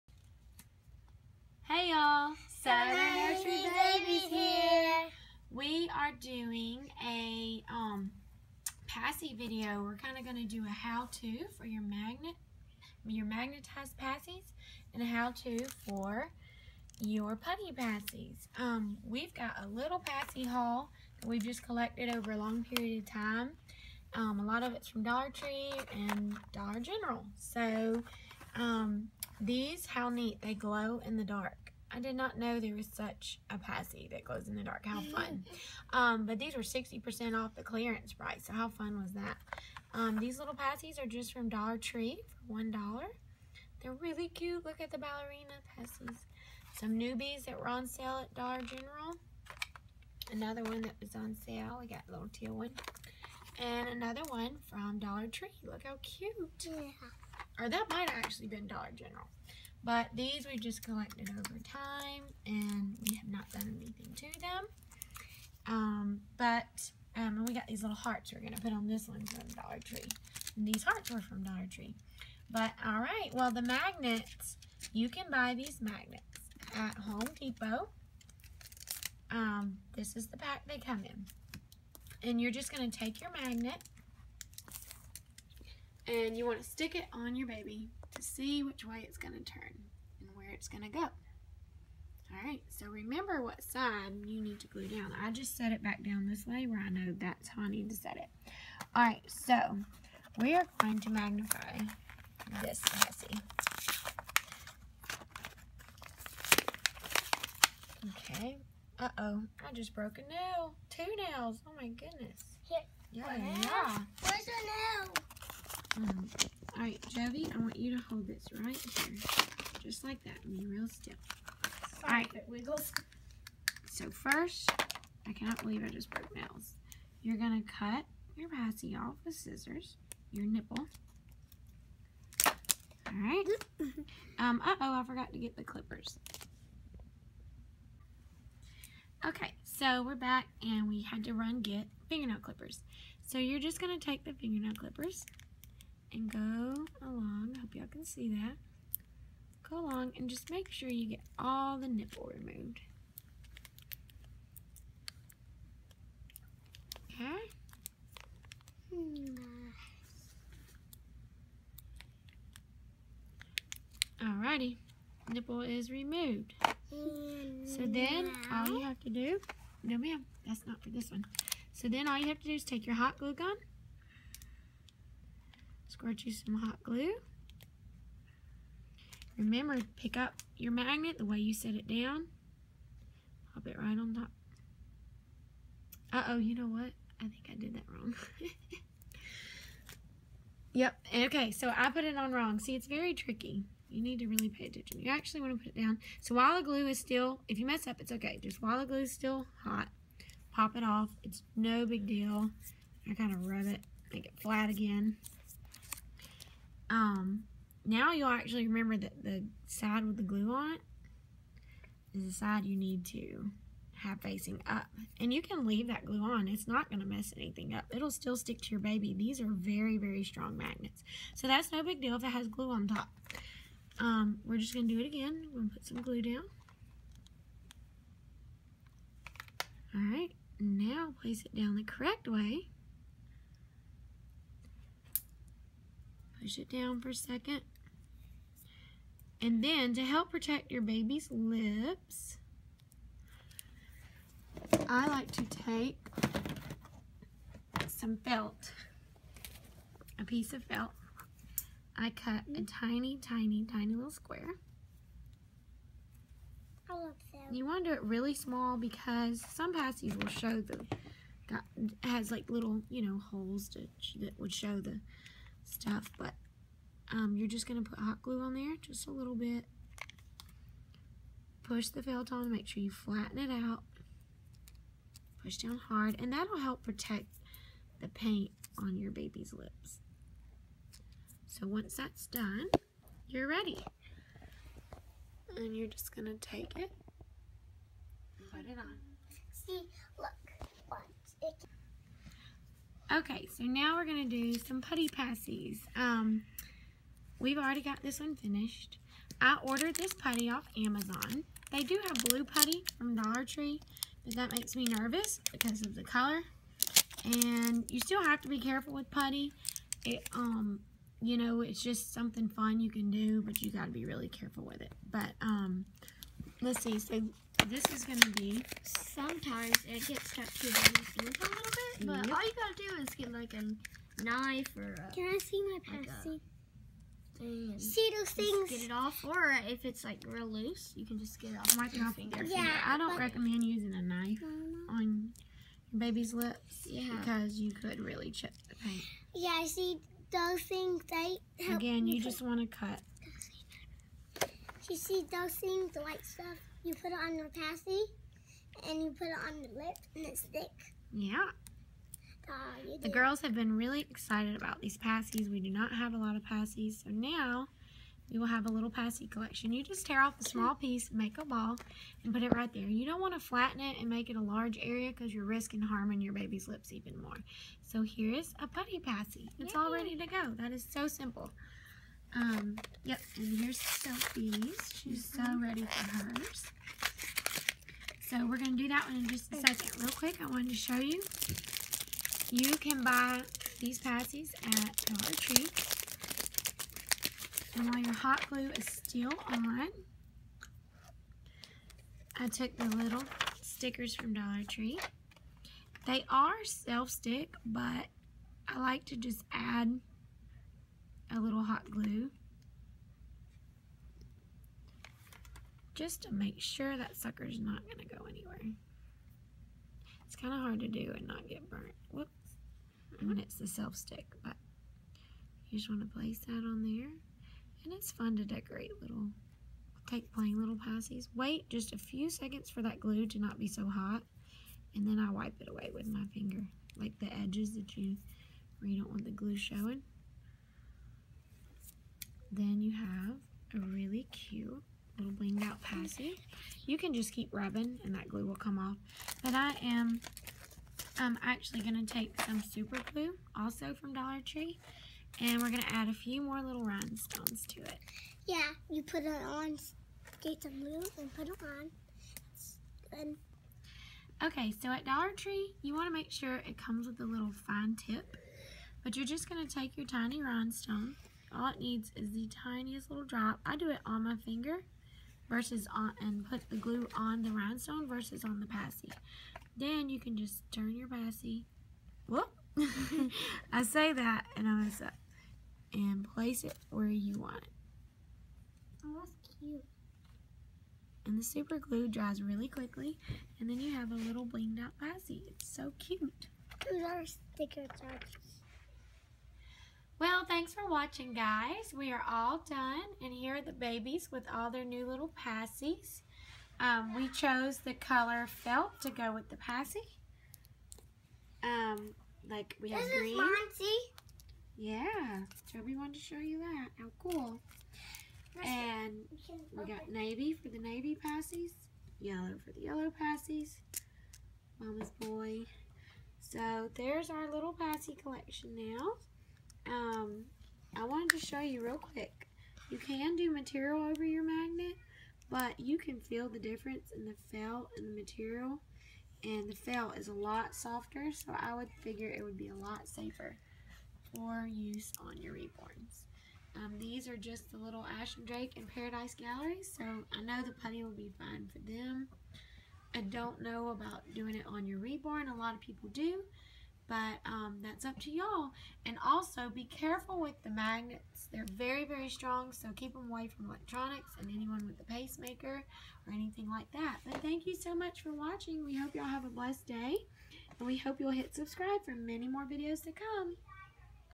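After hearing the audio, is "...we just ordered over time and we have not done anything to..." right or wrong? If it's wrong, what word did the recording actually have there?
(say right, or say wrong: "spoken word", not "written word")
wrong: "collected", not "ordered".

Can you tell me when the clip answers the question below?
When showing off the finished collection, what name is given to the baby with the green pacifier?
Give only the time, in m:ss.
8:23.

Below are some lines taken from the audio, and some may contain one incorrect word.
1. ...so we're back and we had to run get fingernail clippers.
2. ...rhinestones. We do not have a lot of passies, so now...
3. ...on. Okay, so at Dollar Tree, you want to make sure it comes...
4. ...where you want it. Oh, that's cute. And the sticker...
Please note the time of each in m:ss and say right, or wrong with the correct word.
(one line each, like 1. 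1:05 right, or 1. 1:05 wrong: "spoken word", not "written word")
1. 2:19 right
2. 5:54 wrong: "passies", not "rhinestones"
3. 7:33 right
4. 7:56 wrong: "super", not "sticker".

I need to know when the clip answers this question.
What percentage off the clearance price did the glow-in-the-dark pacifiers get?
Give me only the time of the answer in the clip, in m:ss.
0:36.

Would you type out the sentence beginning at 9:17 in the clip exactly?
But thank you so much for watching.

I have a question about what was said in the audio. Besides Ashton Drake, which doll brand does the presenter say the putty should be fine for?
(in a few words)
Paradise Gallery.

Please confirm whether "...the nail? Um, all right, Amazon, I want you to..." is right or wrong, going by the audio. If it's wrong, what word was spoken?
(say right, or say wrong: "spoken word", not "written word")
wrong: "Jovi", not "Amazon".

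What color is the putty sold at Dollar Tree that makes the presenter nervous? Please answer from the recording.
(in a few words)
Blue.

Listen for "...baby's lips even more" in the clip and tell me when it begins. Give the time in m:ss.
6:06.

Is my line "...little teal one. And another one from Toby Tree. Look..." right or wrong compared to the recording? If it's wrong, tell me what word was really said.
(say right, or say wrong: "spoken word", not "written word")
wrong: "Dollar", not "Toby".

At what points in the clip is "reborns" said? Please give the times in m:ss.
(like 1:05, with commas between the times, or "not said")
8:55, 9:04.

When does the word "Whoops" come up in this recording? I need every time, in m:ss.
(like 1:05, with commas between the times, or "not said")
6:52, 7:52.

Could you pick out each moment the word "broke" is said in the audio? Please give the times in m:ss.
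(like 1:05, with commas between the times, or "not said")
1:49, 2:06.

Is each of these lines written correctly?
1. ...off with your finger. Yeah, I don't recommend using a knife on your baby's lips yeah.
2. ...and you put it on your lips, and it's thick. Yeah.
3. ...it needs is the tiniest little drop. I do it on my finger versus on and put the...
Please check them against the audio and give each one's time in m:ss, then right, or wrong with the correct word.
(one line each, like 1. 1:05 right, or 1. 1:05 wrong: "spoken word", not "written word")
1. 5:31 right
2. 5:48 right
3. 7:41 right.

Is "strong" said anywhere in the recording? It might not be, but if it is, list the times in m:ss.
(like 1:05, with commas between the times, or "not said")
3:40, 9:12.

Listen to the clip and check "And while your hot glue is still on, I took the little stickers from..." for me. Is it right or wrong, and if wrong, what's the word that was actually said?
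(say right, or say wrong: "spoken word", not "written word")
right.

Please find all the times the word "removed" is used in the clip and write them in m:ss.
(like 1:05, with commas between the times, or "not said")
2:32, 2:45.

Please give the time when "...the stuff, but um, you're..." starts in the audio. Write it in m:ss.
4:24.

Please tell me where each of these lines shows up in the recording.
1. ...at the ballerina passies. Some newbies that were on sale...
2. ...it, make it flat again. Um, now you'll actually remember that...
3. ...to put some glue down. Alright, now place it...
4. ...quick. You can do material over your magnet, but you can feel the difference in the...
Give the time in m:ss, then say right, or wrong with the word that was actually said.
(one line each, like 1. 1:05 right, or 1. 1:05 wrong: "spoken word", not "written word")
1. 0:44 right
2. 3:23 right
3. 3:45 right
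4. 8:41 right.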